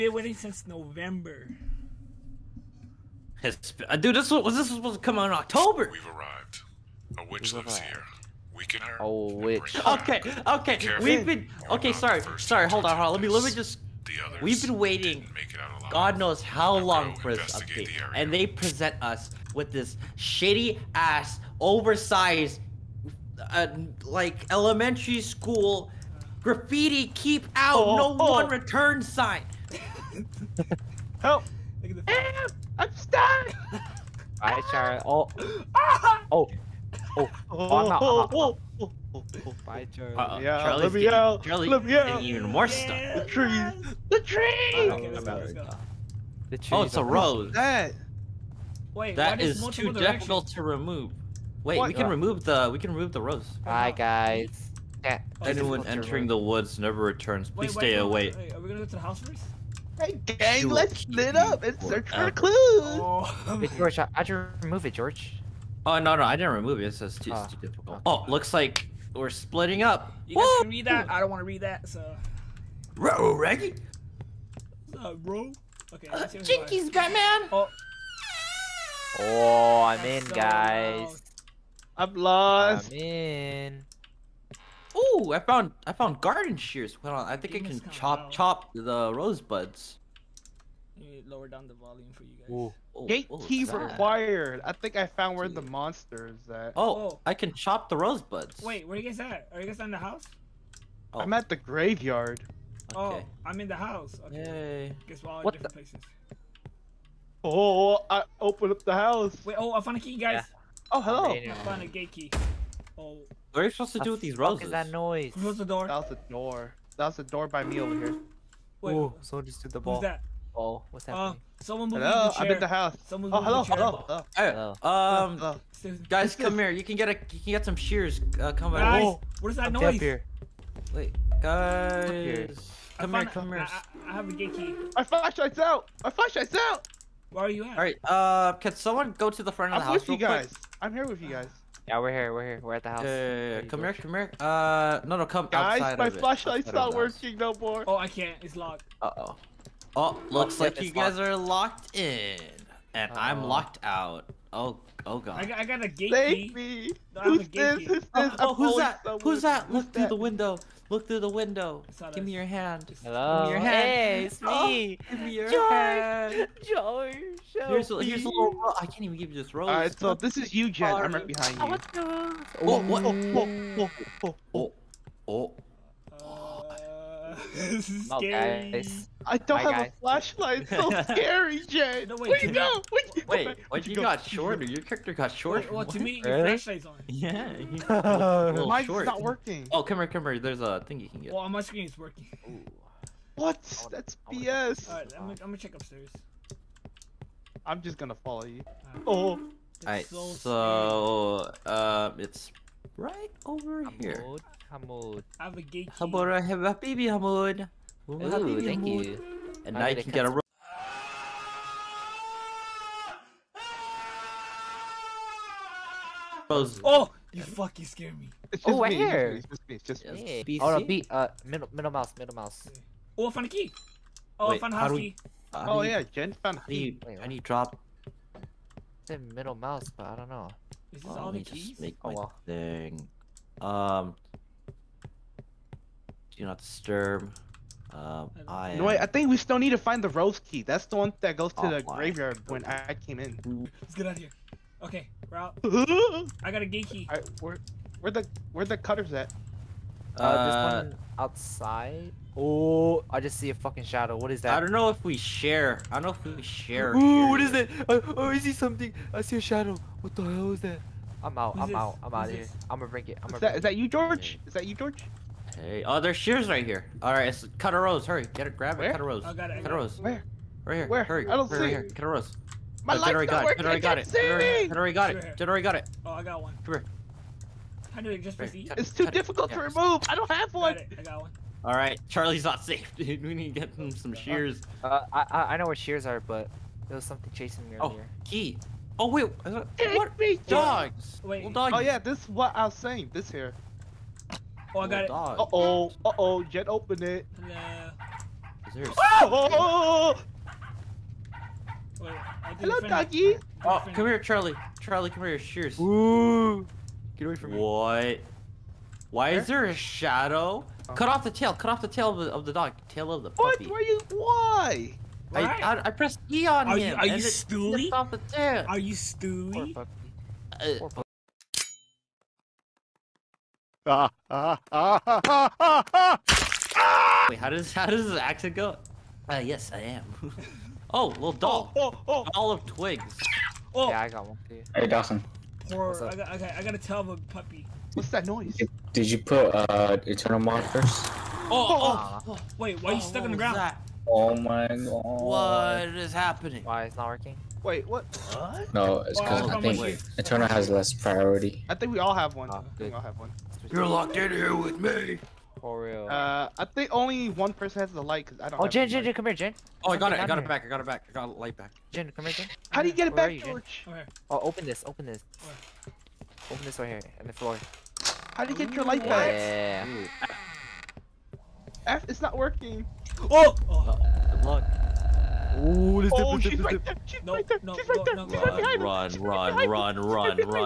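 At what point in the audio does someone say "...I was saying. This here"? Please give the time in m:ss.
4:52.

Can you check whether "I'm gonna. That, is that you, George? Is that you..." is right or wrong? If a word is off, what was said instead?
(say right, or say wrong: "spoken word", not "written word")
right.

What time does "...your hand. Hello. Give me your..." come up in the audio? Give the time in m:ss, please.
2:42.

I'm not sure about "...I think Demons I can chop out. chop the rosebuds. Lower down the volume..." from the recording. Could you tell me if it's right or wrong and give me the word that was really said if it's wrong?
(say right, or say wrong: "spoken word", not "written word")
right.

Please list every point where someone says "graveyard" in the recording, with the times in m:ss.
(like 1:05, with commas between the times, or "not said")
1:41, 4:01.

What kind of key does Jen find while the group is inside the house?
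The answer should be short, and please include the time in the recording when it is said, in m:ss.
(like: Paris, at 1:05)
house key, at 3:44.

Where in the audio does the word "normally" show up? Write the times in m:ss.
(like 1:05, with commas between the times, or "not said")
not said.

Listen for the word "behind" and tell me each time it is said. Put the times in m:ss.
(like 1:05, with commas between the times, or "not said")
2:51, 6:18.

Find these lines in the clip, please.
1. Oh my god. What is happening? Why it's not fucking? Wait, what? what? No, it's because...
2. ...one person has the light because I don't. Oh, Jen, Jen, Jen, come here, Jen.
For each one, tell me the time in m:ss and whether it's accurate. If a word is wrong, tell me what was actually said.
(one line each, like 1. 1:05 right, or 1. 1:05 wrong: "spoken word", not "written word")
1. 5:44 wrong: "working", not "fucking"
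2. 5:57 right.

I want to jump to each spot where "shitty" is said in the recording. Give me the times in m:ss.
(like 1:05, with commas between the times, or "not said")
0:20.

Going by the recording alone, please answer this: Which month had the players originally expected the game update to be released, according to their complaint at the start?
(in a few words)
October.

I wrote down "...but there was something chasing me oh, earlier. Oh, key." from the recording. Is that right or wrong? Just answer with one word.
right.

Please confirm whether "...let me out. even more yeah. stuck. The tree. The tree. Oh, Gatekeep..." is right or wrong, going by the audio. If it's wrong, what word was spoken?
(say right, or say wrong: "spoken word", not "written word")
wrong: "The", not "Gatekeep".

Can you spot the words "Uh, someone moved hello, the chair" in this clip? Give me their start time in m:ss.
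2:01.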